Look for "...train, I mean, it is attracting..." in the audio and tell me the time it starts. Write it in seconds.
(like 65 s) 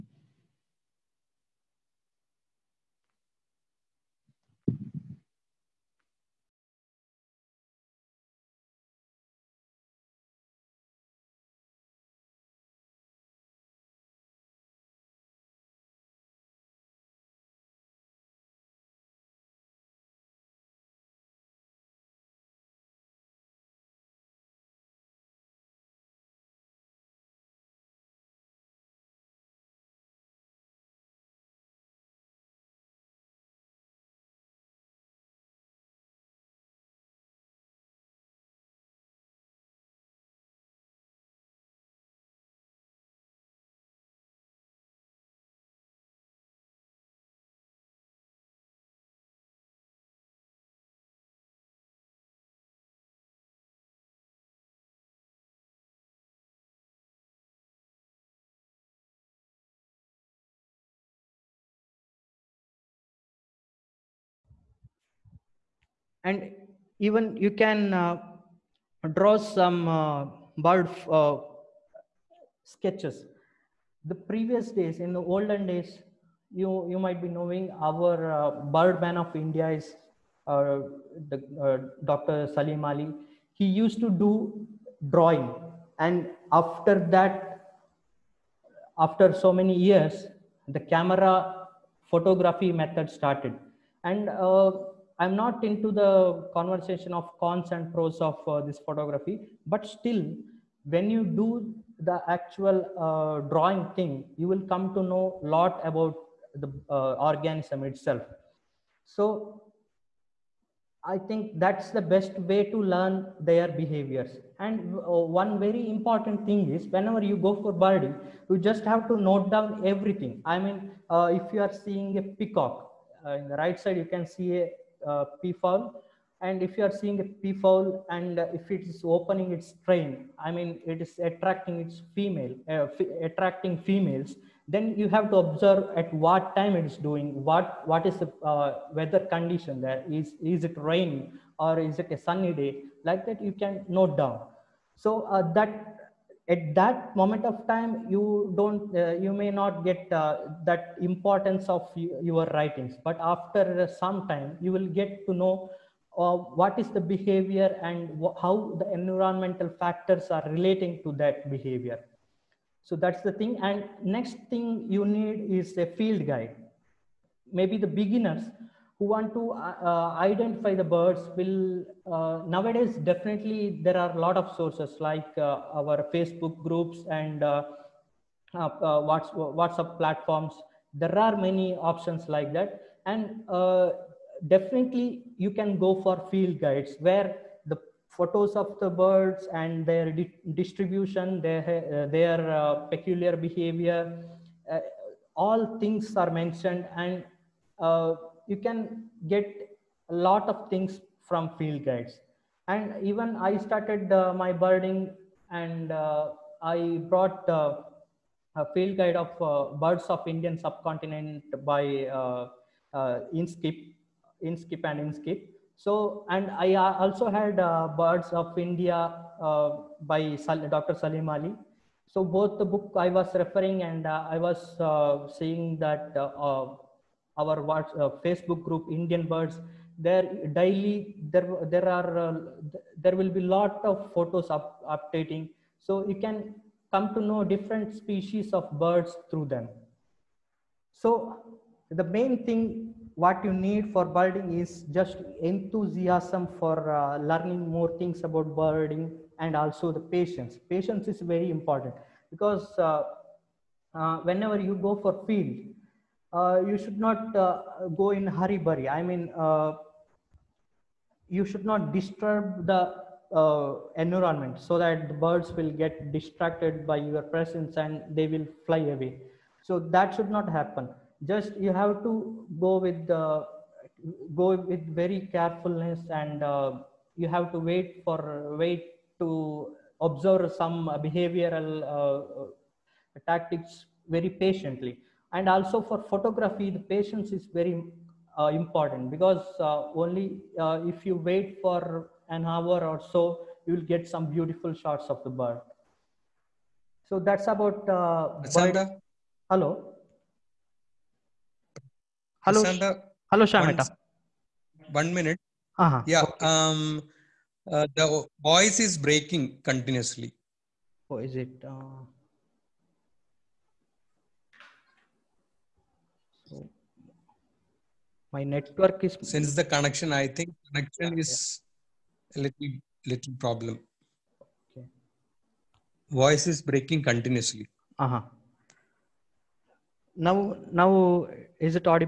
129 s.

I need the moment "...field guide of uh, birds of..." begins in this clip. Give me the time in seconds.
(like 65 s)
208 s.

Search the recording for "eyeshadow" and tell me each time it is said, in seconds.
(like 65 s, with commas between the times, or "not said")
not said.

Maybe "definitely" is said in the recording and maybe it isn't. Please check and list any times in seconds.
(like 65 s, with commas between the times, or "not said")
173 s, 184 s.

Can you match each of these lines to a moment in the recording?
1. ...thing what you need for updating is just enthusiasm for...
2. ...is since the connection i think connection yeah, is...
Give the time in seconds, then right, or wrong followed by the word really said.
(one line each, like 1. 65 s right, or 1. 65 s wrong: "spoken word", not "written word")
1. 242 s wrong: "birding", not "updating"
2. 319 s right.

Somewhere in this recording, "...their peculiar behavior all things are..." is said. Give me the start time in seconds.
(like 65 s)
192 s.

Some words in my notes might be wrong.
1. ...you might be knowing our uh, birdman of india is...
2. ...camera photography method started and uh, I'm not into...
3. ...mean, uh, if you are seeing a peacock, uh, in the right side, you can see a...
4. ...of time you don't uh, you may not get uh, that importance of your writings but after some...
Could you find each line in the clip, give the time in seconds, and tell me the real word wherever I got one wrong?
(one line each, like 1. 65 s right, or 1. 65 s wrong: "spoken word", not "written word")
1. 76 s right
2. 90 s right
3. 120 s right
4. 147 s right.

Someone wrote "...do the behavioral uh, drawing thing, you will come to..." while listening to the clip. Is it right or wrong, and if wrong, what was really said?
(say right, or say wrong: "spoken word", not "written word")
wrong: "actual", not "behavioral".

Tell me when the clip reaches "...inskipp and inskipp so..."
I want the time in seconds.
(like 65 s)
214 s.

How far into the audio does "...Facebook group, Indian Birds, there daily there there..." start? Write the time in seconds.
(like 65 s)
228 s.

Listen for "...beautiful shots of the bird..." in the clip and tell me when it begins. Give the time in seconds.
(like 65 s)
294 s.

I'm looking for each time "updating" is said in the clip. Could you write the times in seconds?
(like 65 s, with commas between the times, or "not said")
234 s.